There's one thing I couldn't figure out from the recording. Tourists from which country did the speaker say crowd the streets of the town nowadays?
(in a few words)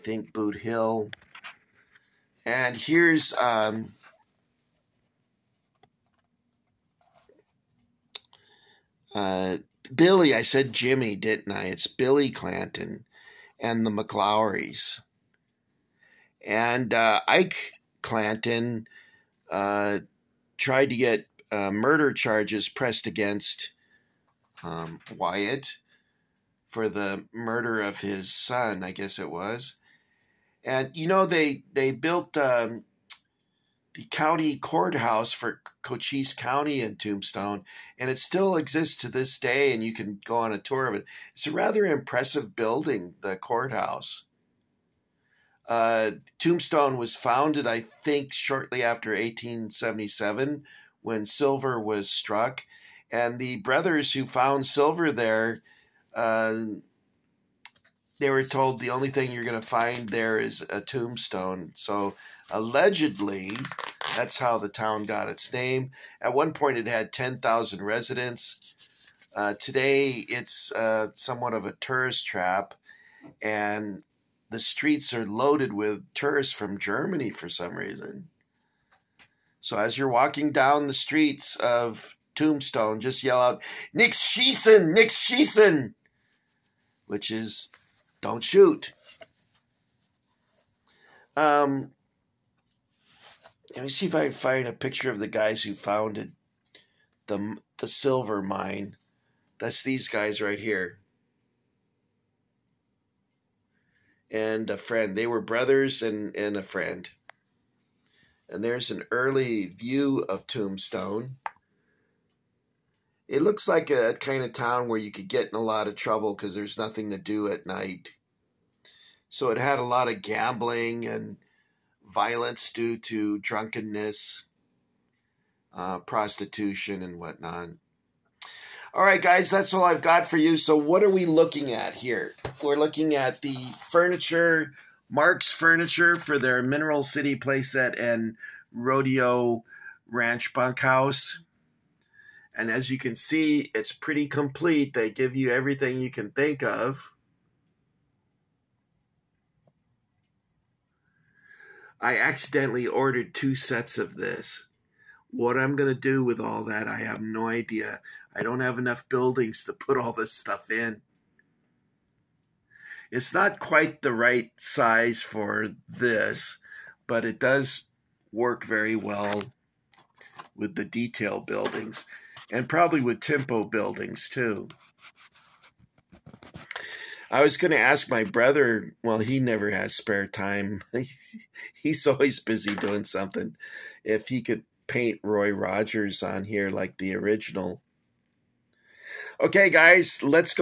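Germany.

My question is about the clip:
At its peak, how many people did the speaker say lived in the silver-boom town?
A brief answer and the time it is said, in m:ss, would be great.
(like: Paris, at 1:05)
10,000, at 1:07.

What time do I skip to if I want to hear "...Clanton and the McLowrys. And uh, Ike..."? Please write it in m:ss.
0:12.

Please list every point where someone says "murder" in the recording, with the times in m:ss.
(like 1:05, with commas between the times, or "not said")
0:21, 0:27.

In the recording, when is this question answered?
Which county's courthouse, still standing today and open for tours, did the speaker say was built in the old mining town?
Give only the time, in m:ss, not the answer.
0:35.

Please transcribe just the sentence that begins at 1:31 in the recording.
Um, let me see if I can find a picture of the guys who founded the, the silver mine.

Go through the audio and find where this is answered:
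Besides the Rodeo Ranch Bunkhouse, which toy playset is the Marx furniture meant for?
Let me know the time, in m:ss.
2:16.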